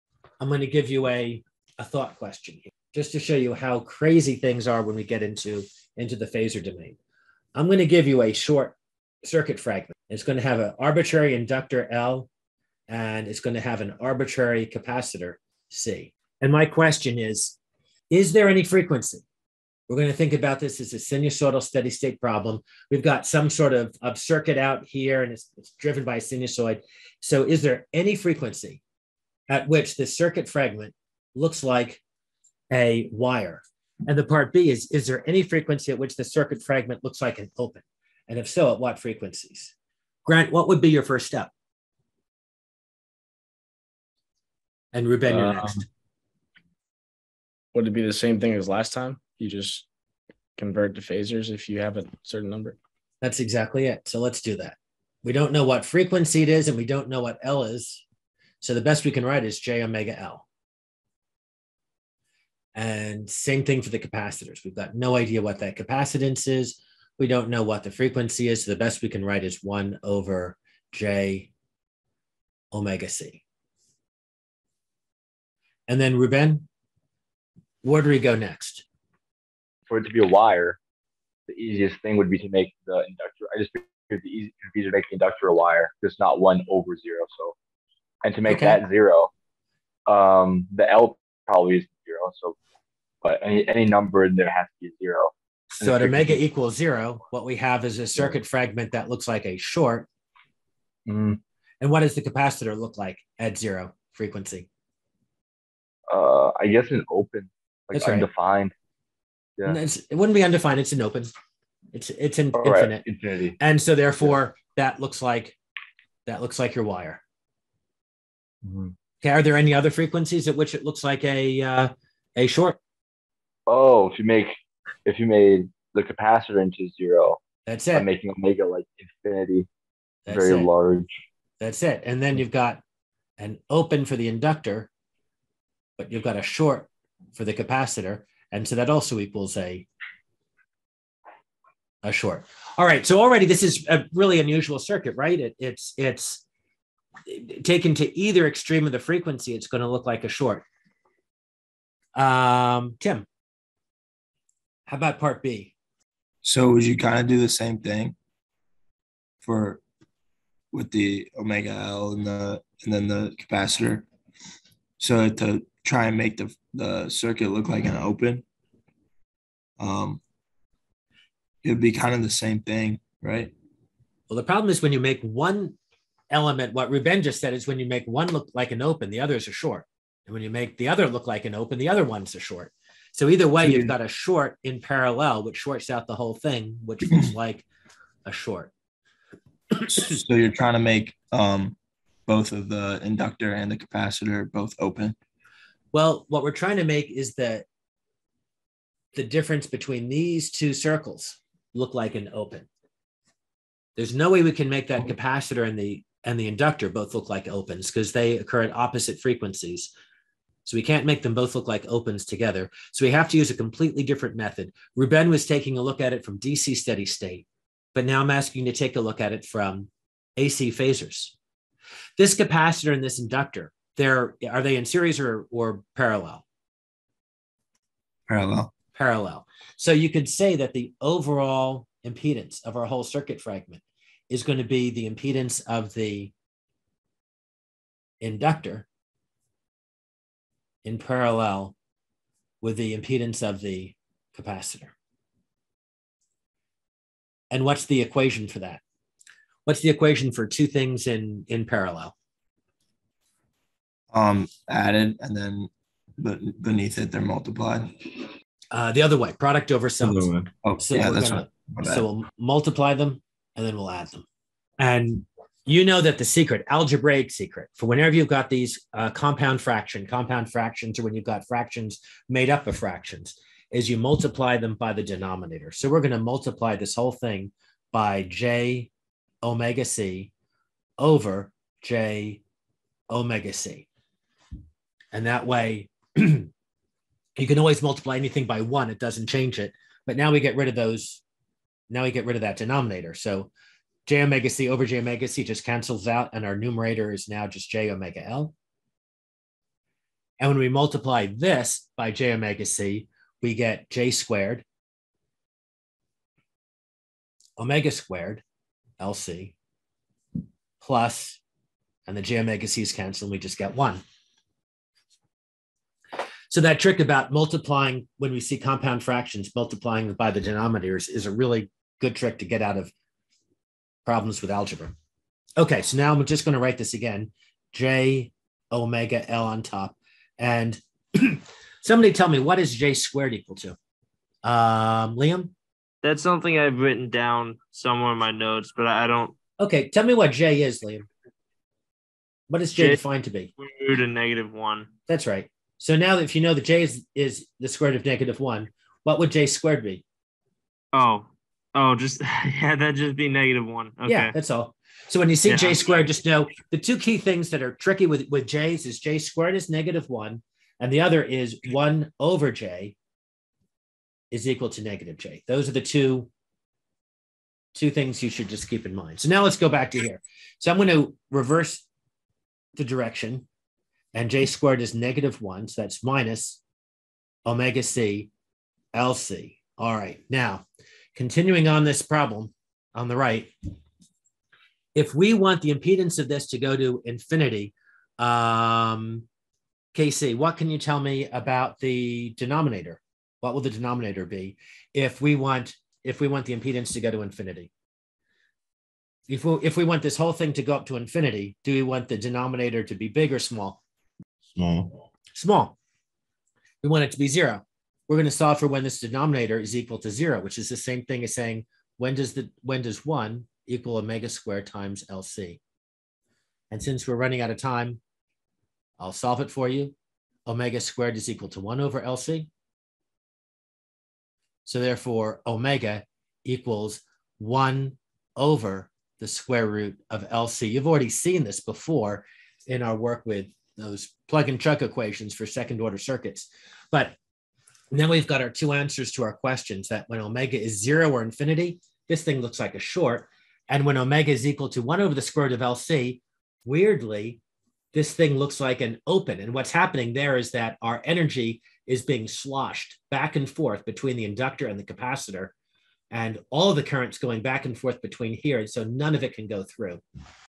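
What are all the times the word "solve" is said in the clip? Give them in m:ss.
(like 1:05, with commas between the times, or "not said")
6:48, 6:59.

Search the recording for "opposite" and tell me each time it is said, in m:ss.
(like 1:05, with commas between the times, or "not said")
3:28.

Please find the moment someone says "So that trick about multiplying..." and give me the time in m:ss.
5:16.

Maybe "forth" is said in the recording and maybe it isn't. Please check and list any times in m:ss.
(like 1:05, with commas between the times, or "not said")
7:33, 7:37.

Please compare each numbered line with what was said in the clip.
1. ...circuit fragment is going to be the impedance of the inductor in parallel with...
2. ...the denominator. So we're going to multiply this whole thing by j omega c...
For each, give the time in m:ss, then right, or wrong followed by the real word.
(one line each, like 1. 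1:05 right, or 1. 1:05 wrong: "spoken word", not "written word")
1. 3:53 right
2. 4:34 right.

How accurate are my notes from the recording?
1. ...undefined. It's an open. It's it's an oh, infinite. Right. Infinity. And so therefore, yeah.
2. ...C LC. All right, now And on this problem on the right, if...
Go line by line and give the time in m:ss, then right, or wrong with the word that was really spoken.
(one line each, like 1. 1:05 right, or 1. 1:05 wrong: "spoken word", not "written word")
1. 1:50 right
2. 6:17 wrong: "Continuing", not "And".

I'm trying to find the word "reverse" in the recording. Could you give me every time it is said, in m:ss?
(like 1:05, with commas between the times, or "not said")
6:11.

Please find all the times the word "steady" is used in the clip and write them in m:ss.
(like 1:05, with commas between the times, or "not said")
0:21, 3:36.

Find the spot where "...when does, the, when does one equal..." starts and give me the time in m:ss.
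6:51.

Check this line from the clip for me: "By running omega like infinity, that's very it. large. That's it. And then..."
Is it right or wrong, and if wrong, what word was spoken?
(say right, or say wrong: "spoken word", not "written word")
wrong: "making", not "running".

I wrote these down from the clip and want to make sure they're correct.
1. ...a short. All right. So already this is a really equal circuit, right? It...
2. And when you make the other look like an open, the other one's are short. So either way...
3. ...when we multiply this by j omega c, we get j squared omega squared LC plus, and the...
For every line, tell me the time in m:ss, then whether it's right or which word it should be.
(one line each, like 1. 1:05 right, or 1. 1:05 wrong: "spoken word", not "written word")
1. 2:22 wrong: "unusual", not "equal"
2. 3:00 right
3. 5:00 right.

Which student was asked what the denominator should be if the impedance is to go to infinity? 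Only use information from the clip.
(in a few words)
Casey.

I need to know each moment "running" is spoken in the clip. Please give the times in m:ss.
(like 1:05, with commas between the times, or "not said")
6:57.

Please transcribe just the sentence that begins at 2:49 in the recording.
Um, it'd be kind of the same thing, right?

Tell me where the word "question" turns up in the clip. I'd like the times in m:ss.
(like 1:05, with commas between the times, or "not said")
0:02, 0:16, 7:19.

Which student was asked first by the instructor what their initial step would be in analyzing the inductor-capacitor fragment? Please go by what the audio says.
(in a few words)
Grant.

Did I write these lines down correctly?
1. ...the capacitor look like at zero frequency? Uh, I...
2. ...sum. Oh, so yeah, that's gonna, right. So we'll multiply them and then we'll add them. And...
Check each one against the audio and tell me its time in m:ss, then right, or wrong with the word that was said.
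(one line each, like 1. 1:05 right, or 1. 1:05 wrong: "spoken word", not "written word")
1. 1:42 right
2. 4:19 right.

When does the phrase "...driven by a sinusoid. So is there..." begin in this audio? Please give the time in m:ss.
0:25.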